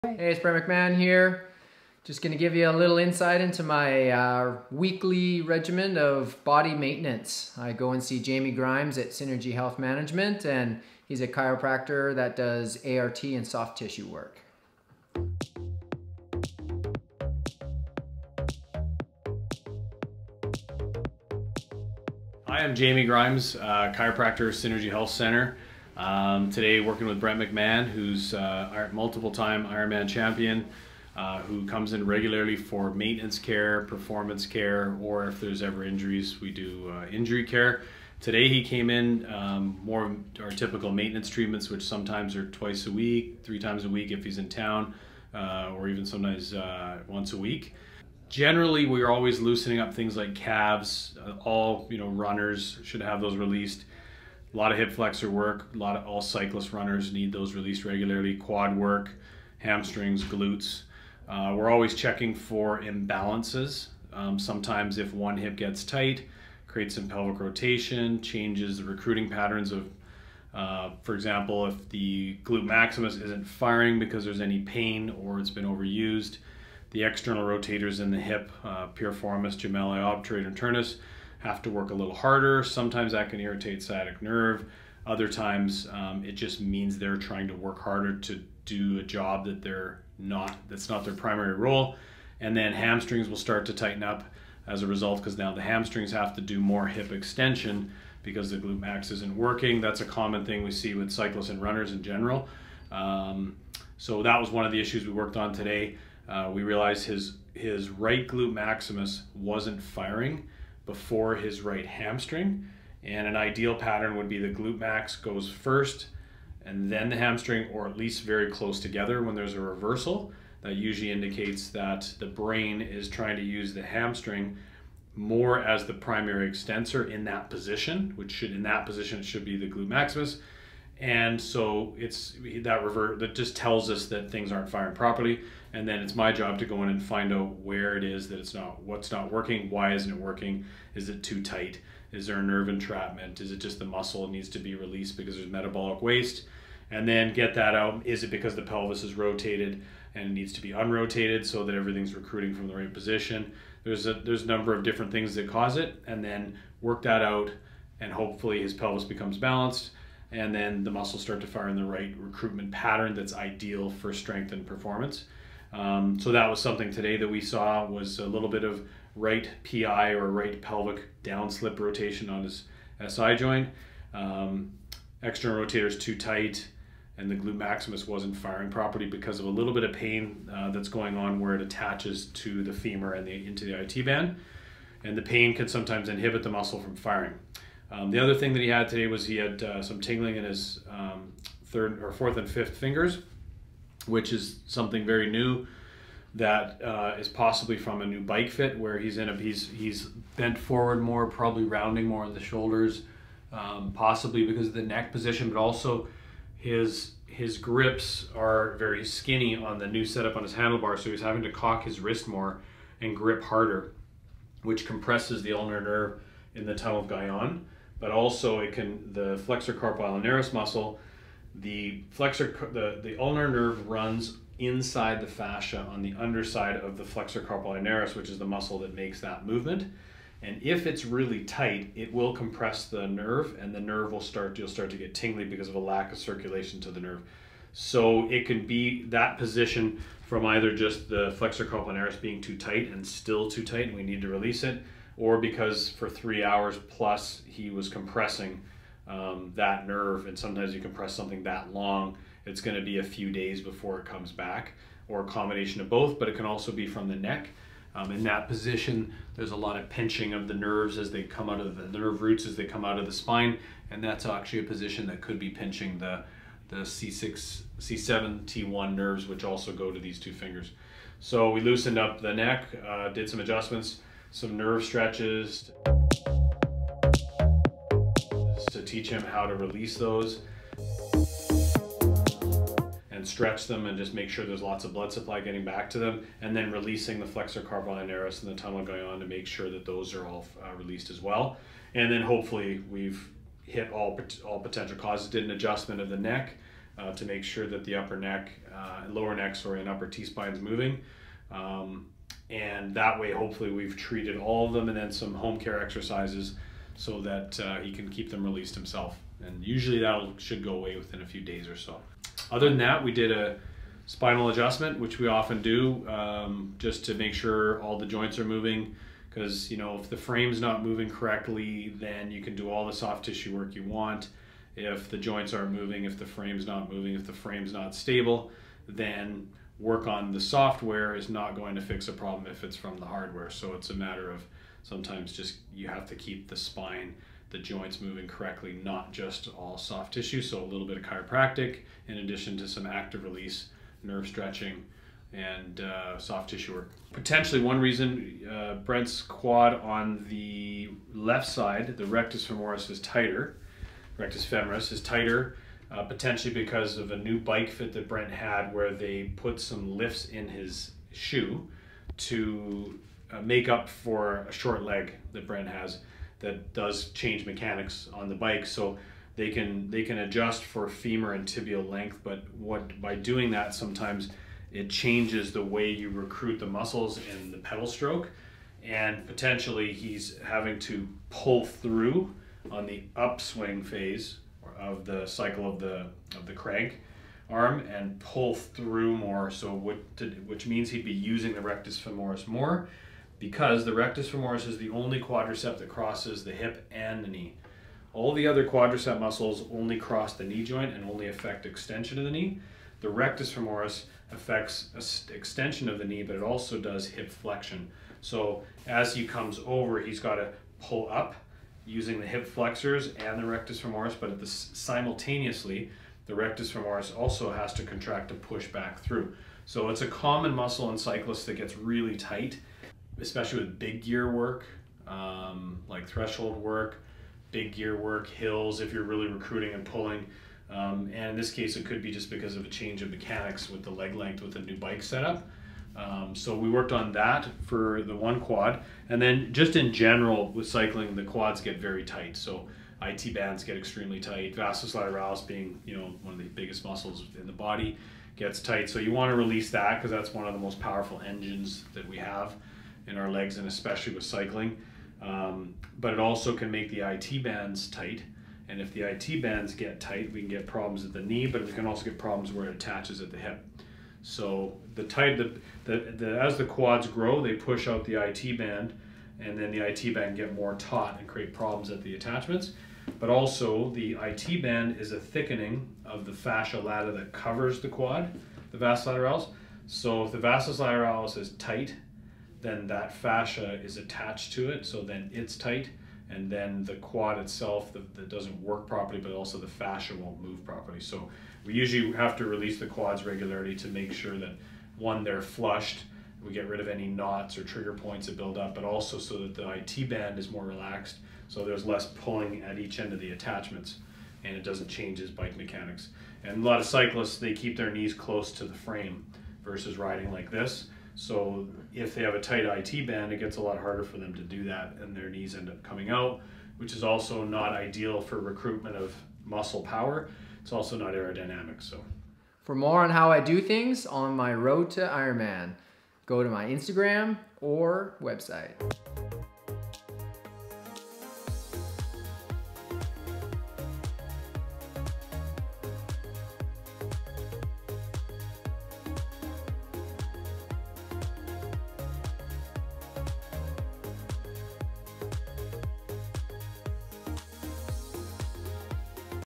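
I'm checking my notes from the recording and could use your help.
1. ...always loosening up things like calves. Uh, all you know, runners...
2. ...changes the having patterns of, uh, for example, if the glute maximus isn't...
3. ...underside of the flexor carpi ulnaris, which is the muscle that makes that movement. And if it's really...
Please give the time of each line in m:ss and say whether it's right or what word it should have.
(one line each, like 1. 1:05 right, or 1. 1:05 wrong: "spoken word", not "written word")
1. 0:49 right
2. 1:08 wrong: "recruiting", not "having"
3. 3:46 right.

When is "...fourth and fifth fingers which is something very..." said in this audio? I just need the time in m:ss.
3:12.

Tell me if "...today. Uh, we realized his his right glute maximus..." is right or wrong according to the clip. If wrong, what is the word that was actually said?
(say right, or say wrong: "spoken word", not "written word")
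right.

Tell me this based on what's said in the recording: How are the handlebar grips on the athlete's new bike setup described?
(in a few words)
very skinny.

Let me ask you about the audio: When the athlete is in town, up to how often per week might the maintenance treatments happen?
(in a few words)
three times a week.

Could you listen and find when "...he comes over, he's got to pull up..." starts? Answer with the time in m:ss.
6:49.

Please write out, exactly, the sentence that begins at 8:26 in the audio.
And a lot of cyclists, they keep their knees close to the frame versus riding like this.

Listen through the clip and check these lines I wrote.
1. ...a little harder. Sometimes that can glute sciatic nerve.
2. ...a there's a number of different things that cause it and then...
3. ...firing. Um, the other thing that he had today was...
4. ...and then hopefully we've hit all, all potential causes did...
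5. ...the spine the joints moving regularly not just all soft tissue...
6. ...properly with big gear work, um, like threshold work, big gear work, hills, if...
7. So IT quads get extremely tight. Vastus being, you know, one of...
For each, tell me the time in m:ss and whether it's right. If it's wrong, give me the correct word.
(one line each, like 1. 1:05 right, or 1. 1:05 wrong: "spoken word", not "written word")
1. 1:21 wrong: "irritate", not "glute"
2. 2:34 right
3. 3:06 right
4. 4:51 right
5. 5:36 wrong: "correctly", not "regularly"
6. 7:03 wrong: "especially", not "properly"
7. 7:22 wrong: "bands", not "quads".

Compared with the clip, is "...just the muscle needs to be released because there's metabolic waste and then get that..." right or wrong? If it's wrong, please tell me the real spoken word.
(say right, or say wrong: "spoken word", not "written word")
right.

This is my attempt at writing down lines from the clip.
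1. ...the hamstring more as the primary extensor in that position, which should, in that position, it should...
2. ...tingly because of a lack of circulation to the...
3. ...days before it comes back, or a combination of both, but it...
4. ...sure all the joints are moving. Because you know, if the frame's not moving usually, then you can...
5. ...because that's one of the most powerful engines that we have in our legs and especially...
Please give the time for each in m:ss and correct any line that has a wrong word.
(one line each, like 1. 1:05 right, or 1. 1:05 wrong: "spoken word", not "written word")
1. 2:03 right
2. 3:55 right
3. 4:13 right
4. 5:17 wrong: "correctly", not "usually"
5. 7:29 right.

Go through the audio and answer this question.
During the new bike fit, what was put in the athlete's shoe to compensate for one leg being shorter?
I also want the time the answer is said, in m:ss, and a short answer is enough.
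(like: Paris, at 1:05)
lifts, at 5:59.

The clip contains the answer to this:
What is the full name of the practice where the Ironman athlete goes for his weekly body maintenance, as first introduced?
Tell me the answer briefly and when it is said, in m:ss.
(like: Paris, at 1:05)
Synergy Health Management, at 0:09.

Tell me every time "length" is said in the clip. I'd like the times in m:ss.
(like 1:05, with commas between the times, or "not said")
6:11, 7:14.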